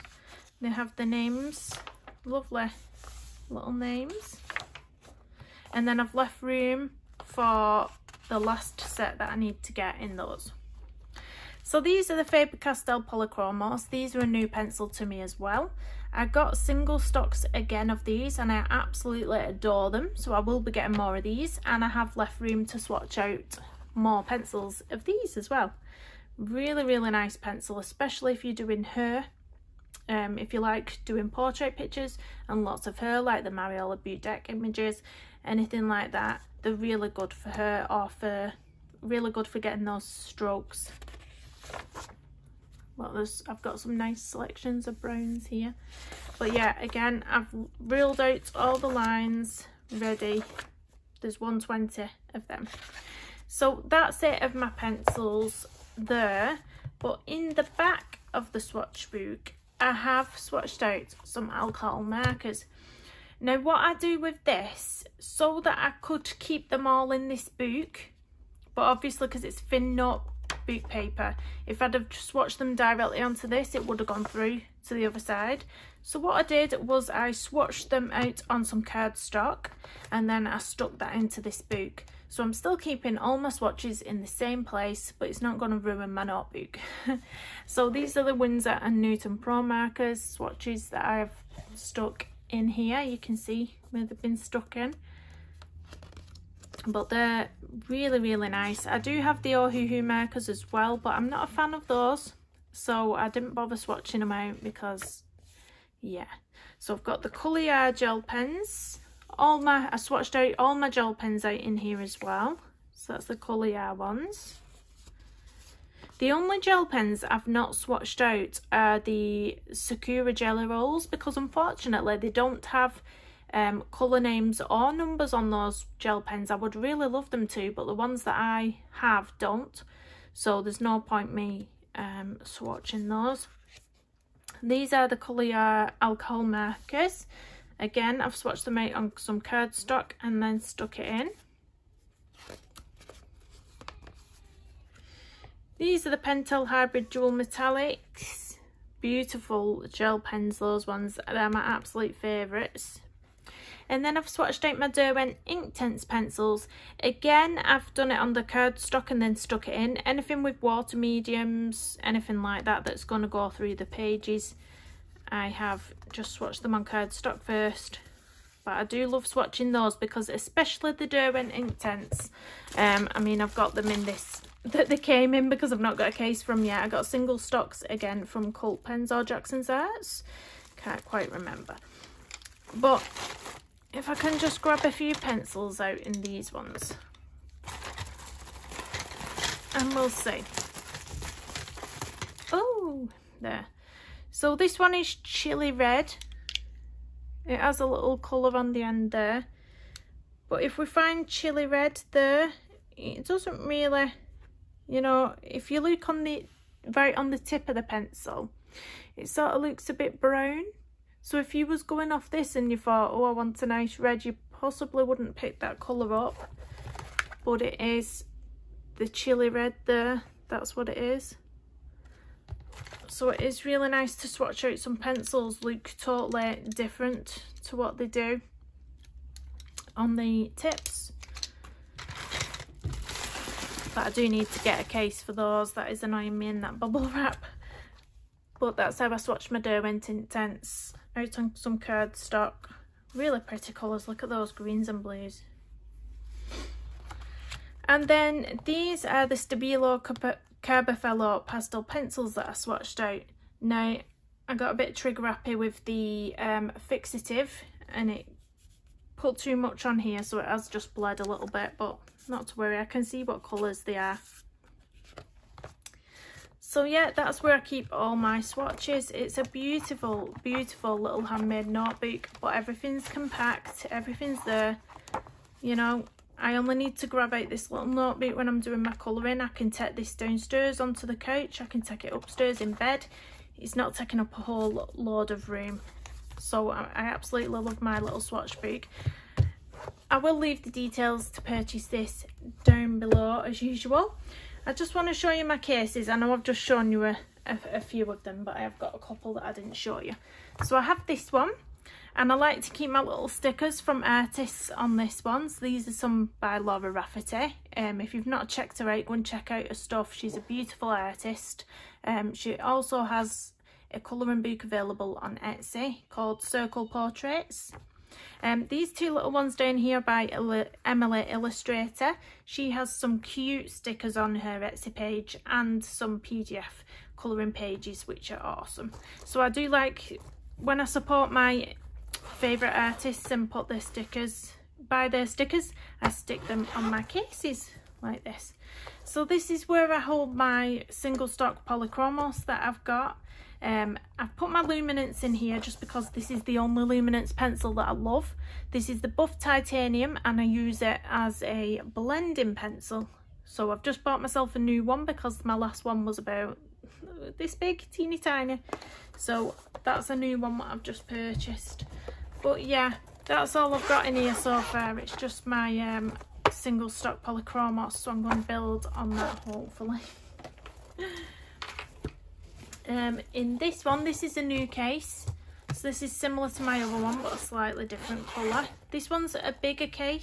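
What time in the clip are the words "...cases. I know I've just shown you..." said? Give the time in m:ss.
4:55.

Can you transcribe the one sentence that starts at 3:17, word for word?
It has a little colour on the end there.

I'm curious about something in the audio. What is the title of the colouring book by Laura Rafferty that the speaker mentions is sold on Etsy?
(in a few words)
Circle Portraits.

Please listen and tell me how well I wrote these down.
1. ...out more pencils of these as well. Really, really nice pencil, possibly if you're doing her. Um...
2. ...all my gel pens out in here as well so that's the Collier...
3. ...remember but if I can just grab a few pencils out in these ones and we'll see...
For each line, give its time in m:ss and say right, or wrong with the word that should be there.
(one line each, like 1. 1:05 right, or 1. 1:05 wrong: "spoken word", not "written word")
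1. 0:23 wrong: "especially", not "possibly"
2. 1:50 right
3. 3:01 right.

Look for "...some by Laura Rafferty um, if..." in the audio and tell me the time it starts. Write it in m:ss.
5:05.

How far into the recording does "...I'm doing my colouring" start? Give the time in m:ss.
4:38.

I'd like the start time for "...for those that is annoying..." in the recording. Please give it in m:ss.
3:55.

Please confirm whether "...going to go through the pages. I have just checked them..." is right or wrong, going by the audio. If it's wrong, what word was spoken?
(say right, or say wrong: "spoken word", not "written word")
wrong: "swatched", not "checked".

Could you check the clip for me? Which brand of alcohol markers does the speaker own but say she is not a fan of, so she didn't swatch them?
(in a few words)
Ohuhu.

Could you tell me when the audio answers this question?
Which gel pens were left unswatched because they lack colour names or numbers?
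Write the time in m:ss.
1:59.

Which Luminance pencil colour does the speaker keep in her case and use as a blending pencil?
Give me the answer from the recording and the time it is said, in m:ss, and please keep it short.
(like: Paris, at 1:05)
Buff Titanium, at 5:49.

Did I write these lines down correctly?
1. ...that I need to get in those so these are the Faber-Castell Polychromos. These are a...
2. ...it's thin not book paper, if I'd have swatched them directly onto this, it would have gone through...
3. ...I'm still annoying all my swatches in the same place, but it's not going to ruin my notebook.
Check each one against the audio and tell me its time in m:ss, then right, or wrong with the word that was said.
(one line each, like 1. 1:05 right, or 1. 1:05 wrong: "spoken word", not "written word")
1. 0:09 right
2. 1:09 right
3. 1:22 wrong: "keeping", not "annoying".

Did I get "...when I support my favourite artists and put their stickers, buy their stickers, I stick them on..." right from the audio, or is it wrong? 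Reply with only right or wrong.
right.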